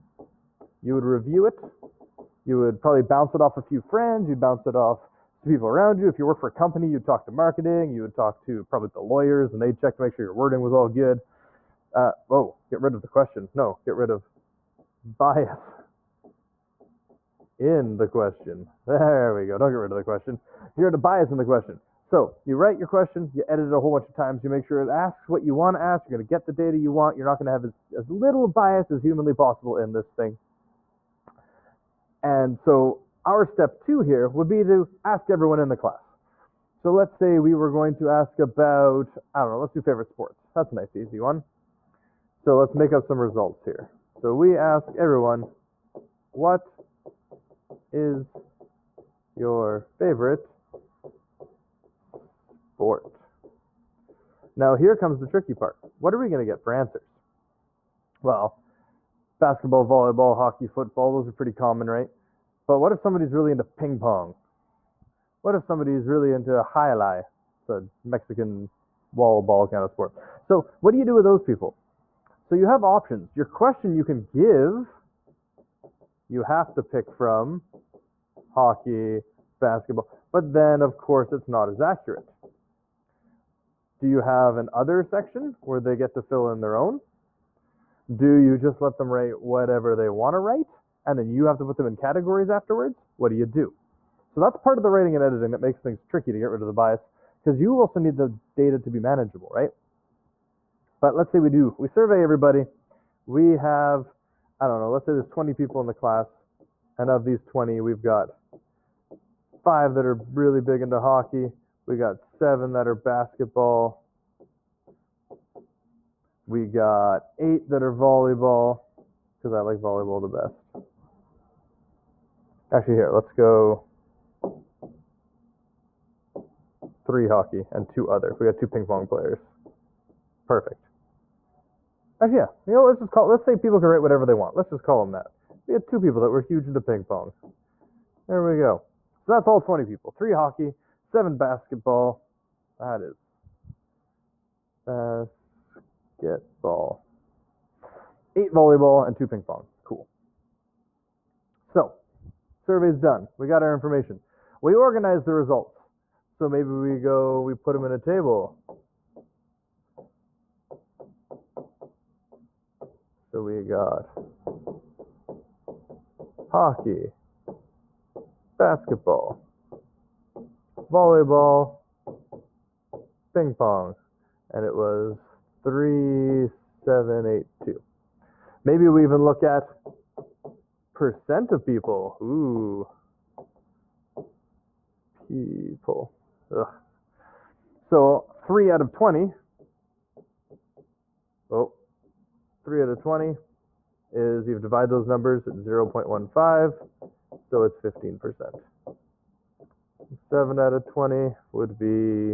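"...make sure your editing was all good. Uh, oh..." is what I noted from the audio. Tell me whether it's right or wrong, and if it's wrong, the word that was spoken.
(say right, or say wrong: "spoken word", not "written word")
wrong: "wording", not "editing".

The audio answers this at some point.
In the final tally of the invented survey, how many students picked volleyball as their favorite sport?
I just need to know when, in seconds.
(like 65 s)
148 s.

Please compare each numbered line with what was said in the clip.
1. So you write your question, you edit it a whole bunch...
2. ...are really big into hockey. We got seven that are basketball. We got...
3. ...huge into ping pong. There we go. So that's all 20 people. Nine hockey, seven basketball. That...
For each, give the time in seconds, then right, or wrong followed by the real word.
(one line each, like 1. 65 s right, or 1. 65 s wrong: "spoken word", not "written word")
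1. 21 s right
2. 110 s right
3. 136 s wrong: "Three", not "Nine".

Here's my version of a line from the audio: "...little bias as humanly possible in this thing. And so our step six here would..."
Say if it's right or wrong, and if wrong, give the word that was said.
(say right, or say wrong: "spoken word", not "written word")
wrong: "two", not "six".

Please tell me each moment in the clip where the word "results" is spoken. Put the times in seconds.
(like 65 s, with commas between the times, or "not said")
43 s, 155 s.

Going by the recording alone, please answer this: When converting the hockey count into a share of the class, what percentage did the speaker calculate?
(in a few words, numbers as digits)
15%.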